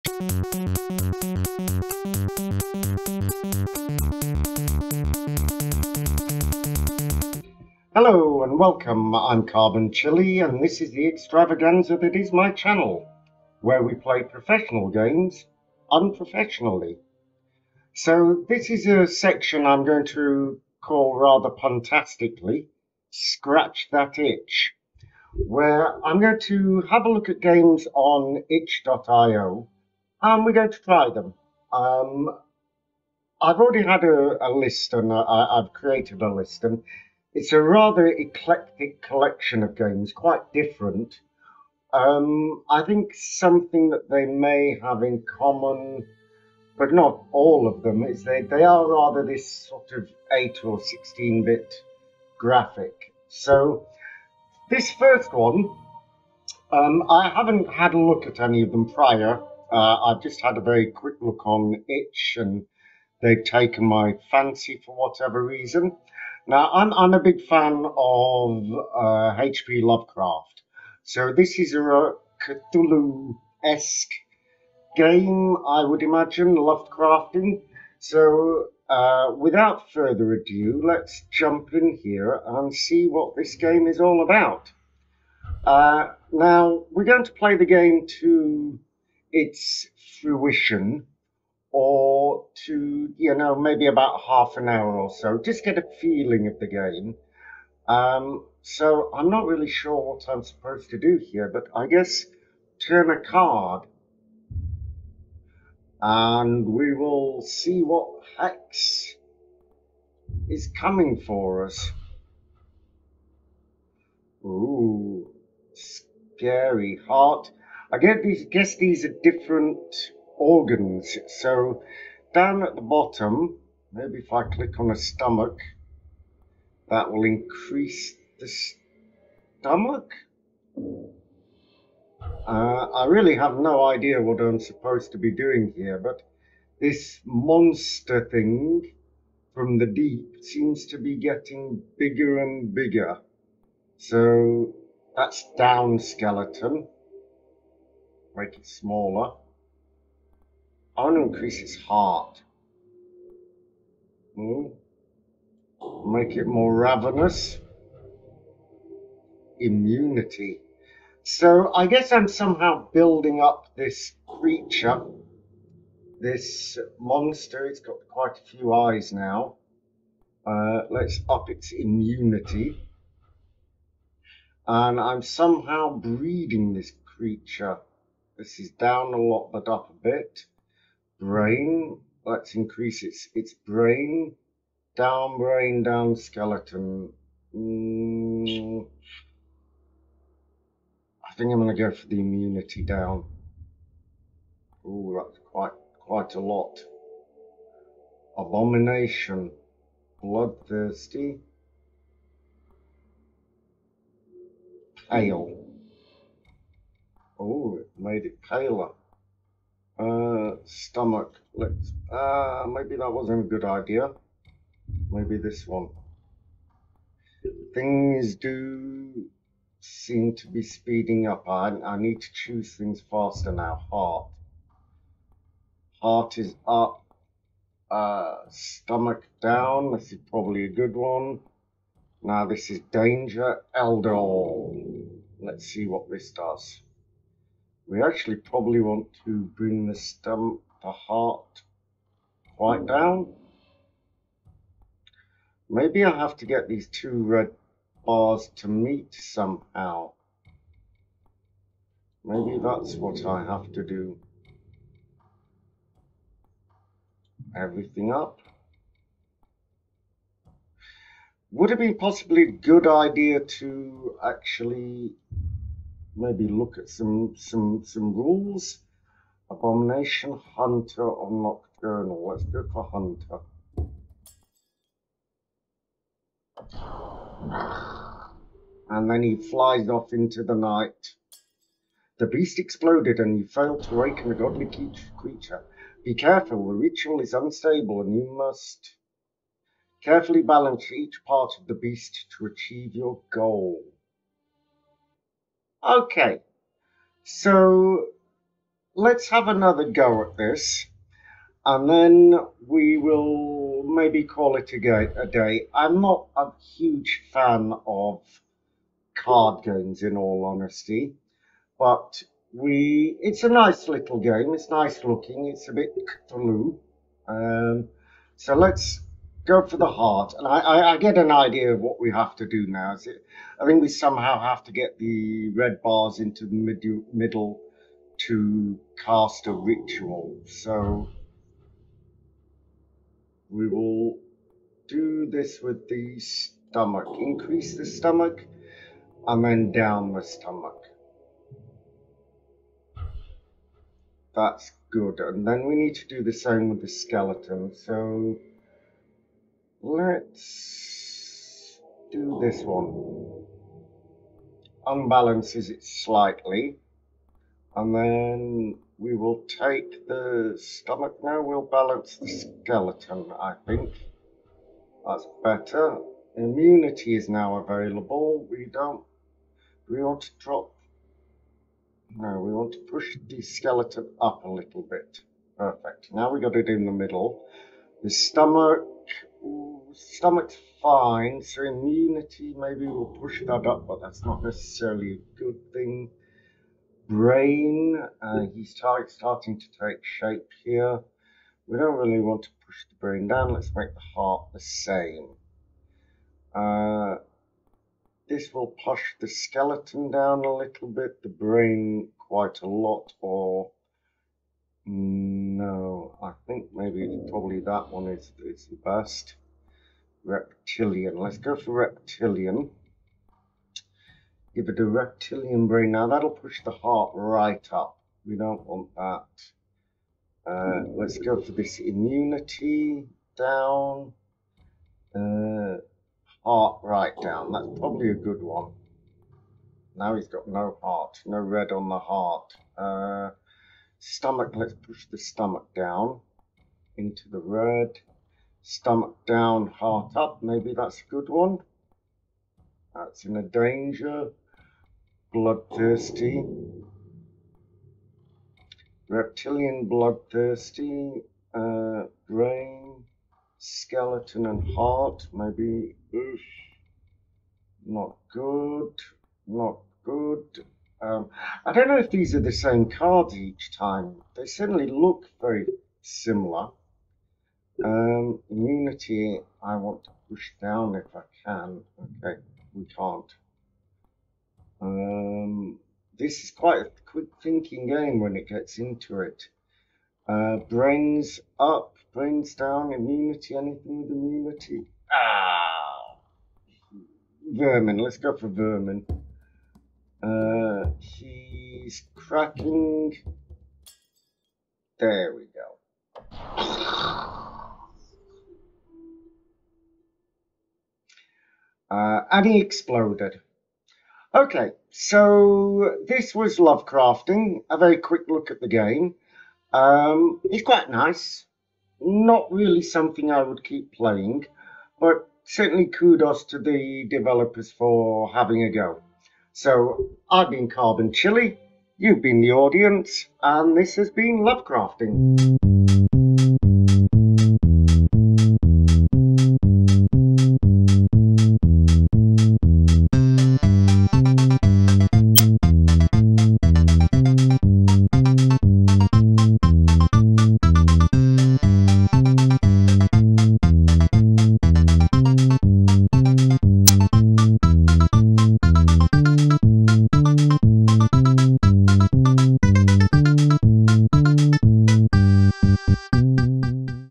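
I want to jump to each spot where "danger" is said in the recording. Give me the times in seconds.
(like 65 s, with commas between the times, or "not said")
232 s, 443 s.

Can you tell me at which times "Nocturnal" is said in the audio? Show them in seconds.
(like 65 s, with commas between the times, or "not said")
271 s.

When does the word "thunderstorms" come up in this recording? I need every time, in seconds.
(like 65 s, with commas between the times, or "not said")
not said.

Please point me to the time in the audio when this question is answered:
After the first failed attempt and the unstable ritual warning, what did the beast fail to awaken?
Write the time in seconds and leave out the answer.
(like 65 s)
284 s.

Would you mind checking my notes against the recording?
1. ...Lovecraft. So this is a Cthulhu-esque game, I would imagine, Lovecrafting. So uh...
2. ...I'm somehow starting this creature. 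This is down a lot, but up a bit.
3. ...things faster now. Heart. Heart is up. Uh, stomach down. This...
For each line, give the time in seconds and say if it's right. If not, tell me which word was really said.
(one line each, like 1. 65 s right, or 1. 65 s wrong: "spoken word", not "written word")
1. 69 s right
2. 174 s wrong: "breeding", not "starting"
3. 222 s right.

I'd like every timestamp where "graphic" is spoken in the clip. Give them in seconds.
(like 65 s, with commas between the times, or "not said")
52 s.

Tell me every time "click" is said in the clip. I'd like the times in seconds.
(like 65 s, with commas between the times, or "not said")
124 s.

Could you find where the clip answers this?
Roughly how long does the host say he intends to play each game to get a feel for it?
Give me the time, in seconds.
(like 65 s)
94 s.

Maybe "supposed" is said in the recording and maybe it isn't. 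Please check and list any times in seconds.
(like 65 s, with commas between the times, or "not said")
100 s, 134 s.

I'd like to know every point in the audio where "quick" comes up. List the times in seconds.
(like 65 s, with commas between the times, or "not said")
60 s, 477 s, 507 s.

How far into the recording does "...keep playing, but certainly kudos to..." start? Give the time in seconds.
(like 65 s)
513 s.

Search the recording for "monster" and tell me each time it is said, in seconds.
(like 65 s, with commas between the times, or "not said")
137 s, 166 s.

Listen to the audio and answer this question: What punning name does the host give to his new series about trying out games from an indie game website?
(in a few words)
Scratch That Itch.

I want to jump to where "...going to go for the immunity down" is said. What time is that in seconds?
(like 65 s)
191 s.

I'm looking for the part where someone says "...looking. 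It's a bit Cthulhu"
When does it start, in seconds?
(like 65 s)
315 s.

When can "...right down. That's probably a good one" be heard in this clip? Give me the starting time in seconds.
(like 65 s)
426 s.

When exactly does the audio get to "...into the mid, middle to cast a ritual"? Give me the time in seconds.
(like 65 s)
326 s.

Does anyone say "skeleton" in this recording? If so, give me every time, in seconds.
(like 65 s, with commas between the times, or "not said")
145 s, 186 s, 346 s, 362 s, 373 s, 399 s, 453 s.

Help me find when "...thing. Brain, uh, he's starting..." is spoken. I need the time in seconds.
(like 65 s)
385 s.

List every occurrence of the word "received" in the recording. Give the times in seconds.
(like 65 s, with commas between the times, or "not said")
not said.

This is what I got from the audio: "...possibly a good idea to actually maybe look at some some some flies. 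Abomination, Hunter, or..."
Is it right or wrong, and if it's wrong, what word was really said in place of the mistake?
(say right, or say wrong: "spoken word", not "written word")
wrong: "rules", not "flies".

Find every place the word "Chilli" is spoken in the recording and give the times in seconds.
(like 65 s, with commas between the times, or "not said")
9 s, 521 s.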